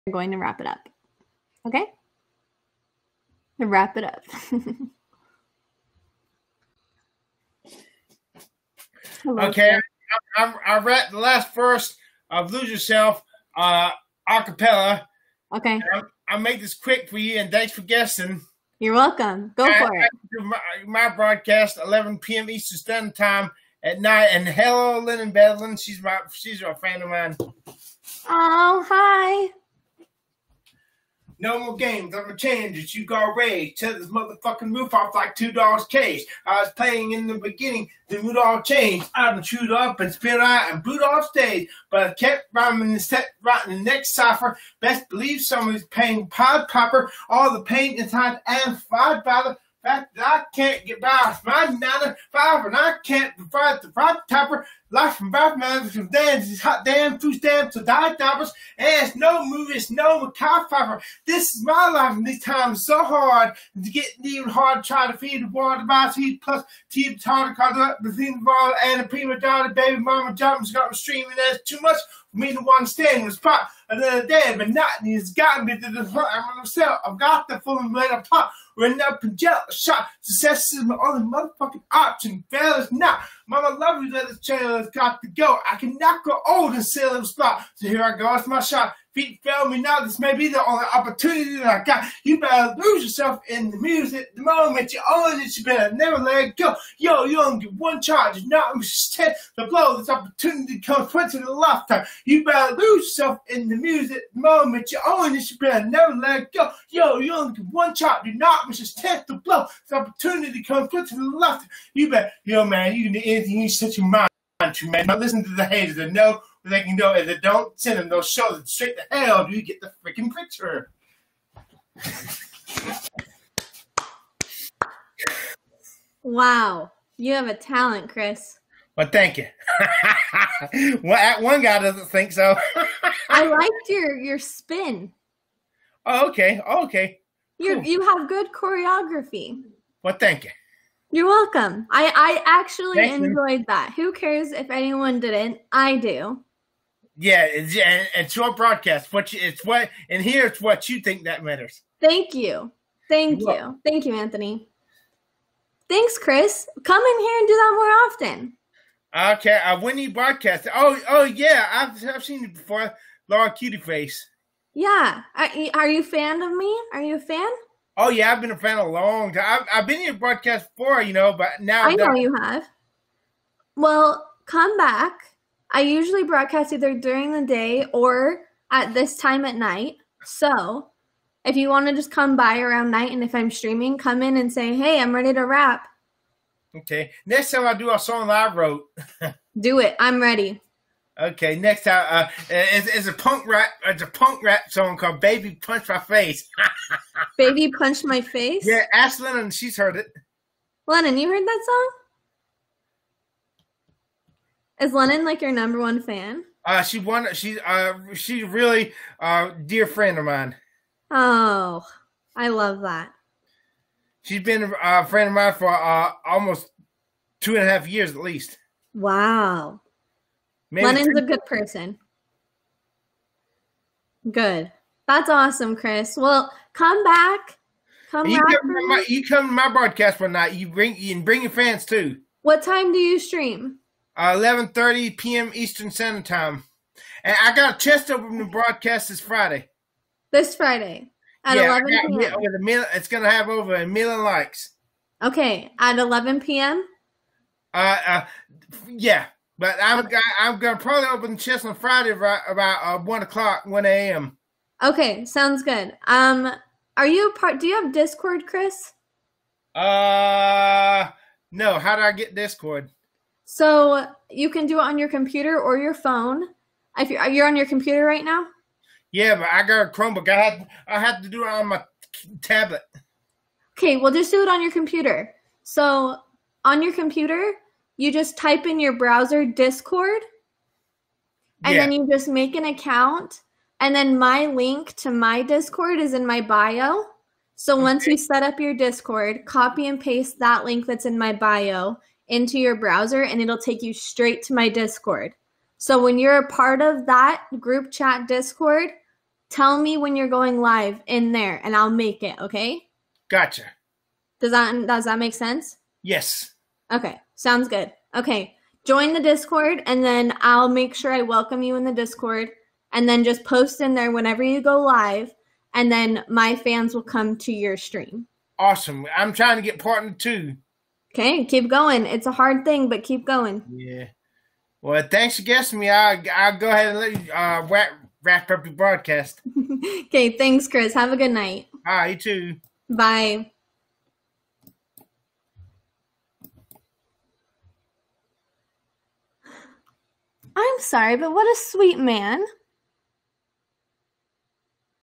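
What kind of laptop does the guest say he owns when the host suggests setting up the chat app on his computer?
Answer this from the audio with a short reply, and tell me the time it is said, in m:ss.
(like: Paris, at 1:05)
Chromebook, at 4:29.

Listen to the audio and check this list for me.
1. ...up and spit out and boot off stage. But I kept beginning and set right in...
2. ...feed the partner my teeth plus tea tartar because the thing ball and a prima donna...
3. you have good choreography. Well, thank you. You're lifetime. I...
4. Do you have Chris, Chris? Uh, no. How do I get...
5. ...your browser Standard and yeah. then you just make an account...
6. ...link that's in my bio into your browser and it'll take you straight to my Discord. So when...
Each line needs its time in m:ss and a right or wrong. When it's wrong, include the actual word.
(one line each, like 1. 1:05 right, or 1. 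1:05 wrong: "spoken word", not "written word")
1. 0:39 wrong: "rhyming", not "beginning"
2. 1:05 wrong: "water", not "partner"
3. 2:17 wrong: "welcome", not "lifetime"
4. 4:17 wrong: "Discord", not "Chris"
5. 4:38 wrong: "Discord", not "Standard"
6. 4:50 right.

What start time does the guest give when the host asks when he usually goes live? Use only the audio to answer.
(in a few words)
11:30 p.m.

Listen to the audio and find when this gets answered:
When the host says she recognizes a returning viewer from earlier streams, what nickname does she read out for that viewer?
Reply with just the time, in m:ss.
2:43.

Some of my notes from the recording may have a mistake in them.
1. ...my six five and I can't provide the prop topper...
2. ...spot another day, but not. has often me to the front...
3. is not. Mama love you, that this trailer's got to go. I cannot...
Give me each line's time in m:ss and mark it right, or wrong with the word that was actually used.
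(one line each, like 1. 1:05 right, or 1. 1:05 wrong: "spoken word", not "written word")
1. 0:51 wrong: "nine", not "six"
2. 1:13 wrong: "gotten", not "often"
3. 1:22 right.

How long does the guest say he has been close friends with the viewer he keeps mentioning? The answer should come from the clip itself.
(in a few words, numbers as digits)
2 and a half years.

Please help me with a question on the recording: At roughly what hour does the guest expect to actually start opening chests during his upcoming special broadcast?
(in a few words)
1 a.m.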